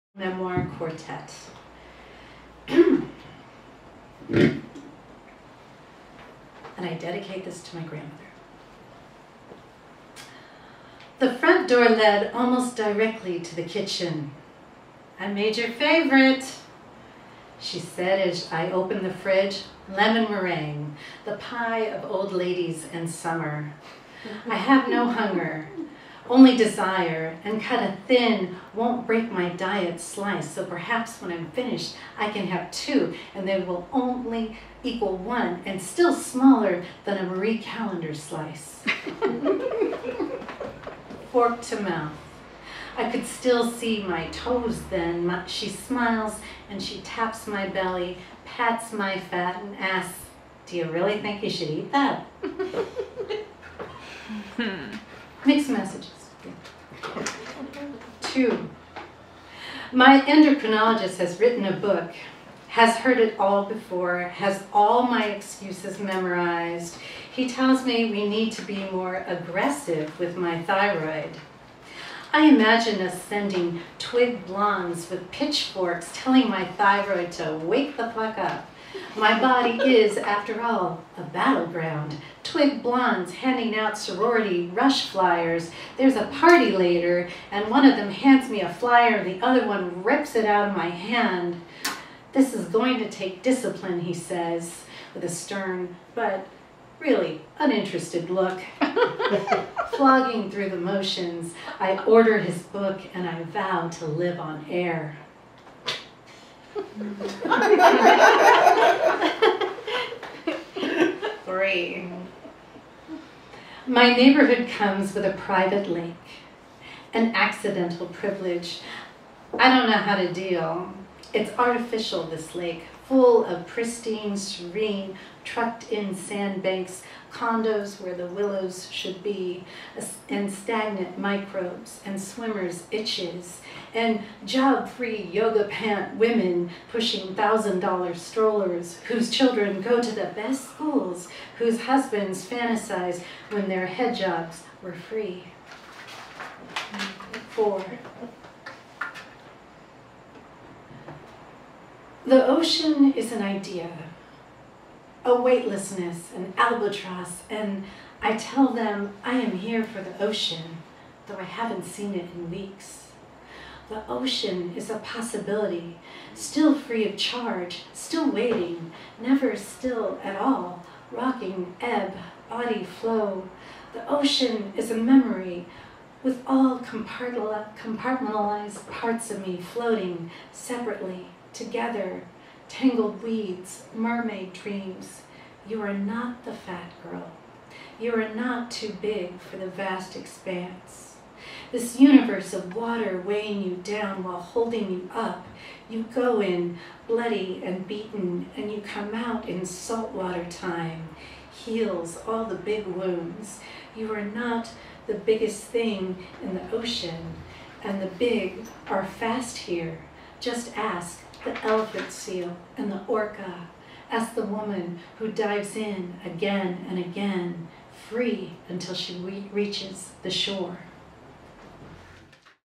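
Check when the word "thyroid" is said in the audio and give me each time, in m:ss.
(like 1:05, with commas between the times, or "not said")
1:10, 1:16.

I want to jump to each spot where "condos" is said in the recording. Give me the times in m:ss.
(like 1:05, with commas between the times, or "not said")
2:07.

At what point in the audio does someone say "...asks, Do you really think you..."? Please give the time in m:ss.
0:49.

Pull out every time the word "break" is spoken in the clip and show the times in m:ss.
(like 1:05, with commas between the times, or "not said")
0:29.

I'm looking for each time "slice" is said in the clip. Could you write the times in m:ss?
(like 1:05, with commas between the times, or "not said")
0:29, 0:38.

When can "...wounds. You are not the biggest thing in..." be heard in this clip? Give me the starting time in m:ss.
3:22.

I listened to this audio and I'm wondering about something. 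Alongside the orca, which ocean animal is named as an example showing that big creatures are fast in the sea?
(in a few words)
elephant seal.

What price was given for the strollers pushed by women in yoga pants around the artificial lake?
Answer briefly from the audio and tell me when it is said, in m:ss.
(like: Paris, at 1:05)
$1,000, at 2:17.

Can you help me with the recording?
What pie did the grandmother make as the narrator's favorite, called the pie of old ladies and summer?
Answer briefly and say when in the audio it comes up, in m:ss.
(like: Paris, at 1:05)
lemon meringue, at 0:19.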